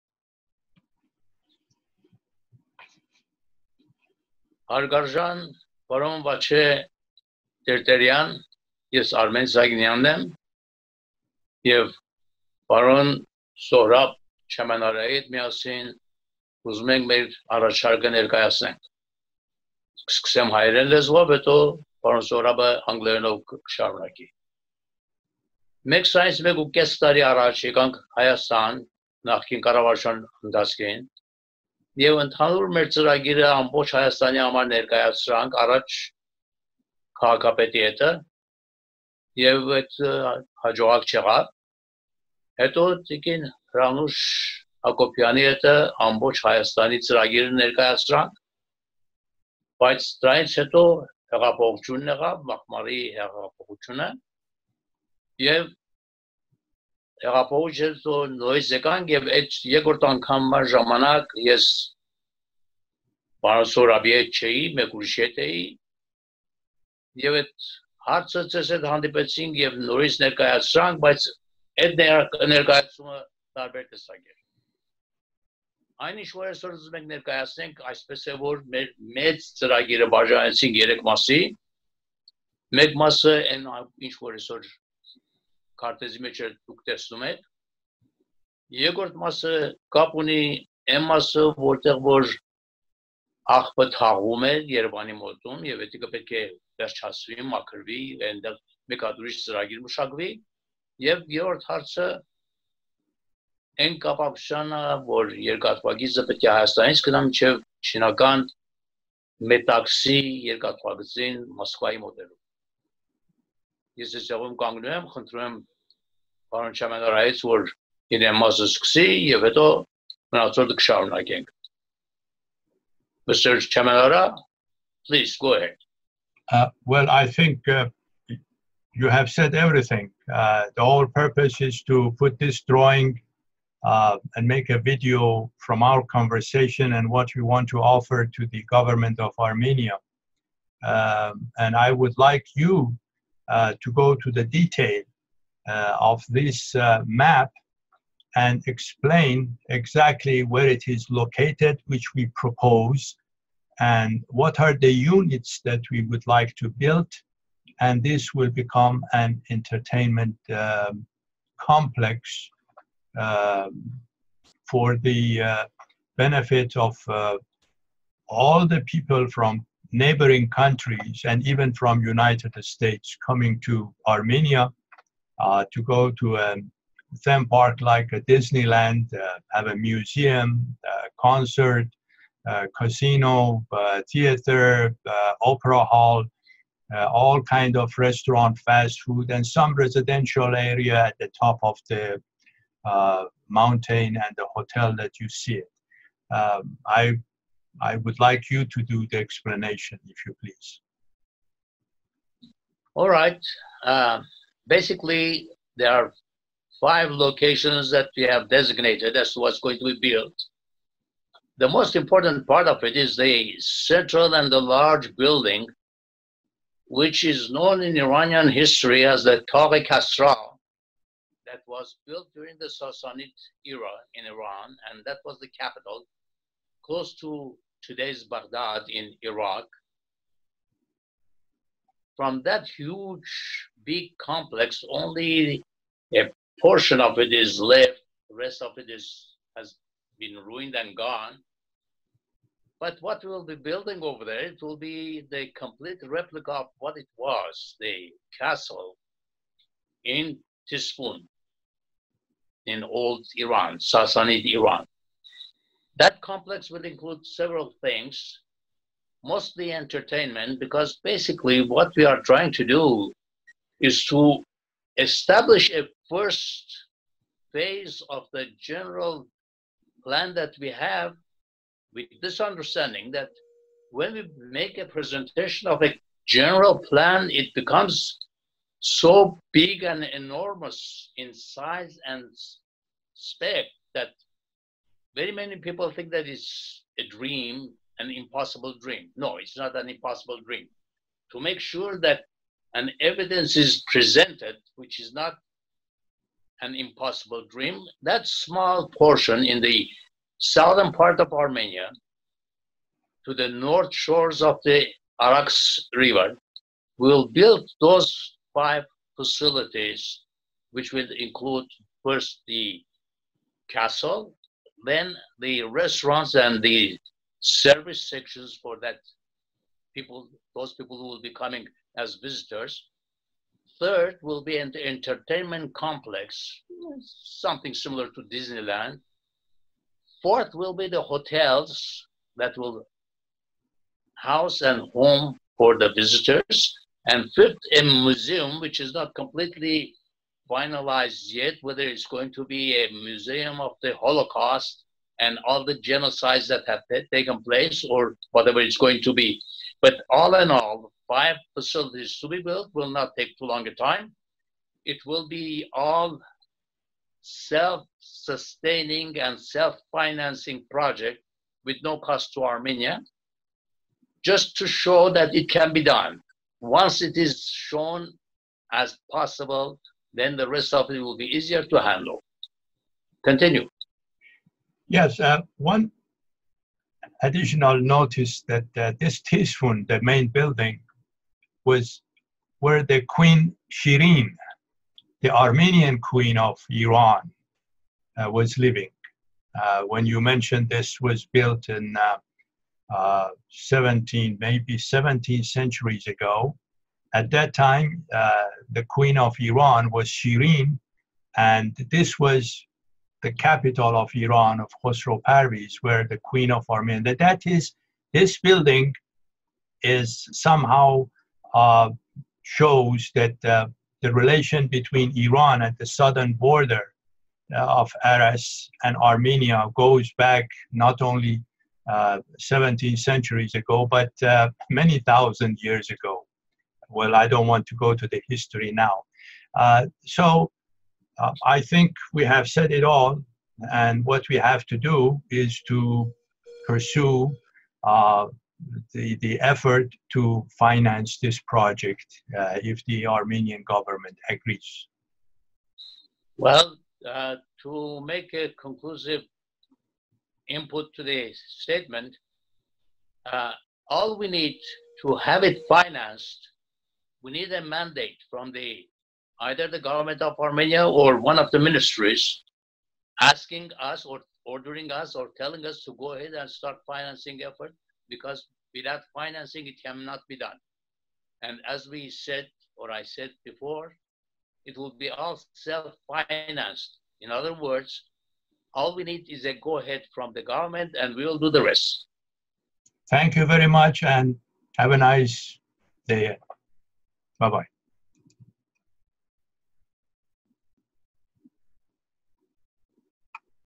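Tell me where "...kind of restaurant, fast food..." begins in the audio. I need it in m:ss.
3:07.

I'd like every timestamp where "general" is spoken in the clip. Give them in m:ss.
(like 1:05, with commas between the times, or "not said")
4:28, 4:36.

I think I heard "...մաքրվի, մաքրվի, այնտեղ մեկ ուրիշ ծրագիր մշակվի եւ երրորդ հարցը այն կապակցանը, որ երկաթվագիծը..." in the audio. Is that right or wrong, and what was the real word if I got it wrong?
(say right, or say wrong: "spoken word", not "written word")
wrong: "վերջացվի", not "մաքրվի".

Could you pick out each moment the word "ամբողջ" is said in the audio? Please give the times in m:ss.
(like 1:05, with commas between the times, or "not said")
0:33, 0:46.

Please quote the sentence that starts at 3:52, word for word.
From that huge big complex, only a portion of it is left, the rest of it is, has been ruined and gone.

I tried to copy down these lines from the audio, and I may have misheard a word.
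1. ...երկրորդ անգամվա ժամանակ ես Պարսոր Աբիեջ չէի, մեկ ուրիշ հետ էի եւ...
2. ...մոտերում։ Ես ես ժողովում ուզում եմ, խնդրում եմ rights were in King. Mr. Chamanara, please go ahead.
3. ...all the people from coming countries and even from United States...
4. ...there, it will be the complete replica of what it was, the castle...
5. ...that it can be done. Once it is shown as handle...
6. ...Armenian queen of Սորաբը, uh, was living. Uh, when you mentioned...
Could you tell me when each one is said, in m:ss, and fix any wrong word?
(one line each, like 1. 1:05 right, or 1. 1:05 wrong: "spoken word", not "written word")
1. 0:59 right
2. 1:52 wrong: "կանգնում", not "ուզում"
3. 2:48 wrong: "neighboring", not "coming"
4. 4:04 right
5. 6:05 wrong: "possible", not "handle"
6. 6:25 wrong: "Iran", not "Սորաբը".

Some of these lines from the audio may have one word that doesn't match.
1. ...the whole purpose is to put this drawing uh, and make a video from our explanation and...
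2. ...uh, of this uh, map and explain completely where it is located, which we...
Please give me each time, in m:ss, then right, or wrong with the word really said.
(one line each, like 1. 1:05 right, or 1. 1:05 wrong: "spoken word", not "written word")
1. 2:10 wrong: "conversation", not "explanation"
2. 2:25 wrong: "exactly", not "completely".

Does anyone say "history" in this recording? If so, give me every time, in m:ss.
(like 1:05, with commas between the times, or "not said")
3:38, 7:08.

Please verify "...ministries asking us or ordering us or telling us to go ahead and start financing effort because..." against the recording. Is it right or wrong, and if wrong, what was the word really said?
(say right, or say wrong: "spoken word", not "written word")
right.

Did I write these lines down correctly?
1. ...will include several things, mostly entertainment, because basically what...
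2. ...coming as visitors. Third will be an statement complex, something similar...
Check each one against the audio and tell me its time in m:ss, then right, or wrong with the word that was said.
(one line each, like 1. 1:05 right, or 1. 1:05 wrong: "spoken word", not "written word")
1. 4:16 right
2. 5:21 wrong: "entertainment", not "statement".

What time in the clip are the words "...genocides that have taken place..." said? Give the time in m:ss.
5:45.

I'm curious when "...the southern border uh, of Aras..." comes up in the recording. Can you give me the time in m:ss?
6:55.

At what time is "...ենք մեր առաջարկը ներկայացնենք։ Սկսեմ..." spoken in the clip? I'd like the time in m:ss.
0:16.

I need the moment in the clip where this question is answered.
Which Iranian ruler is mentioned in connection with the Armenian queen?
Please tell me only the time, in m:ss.
6:44.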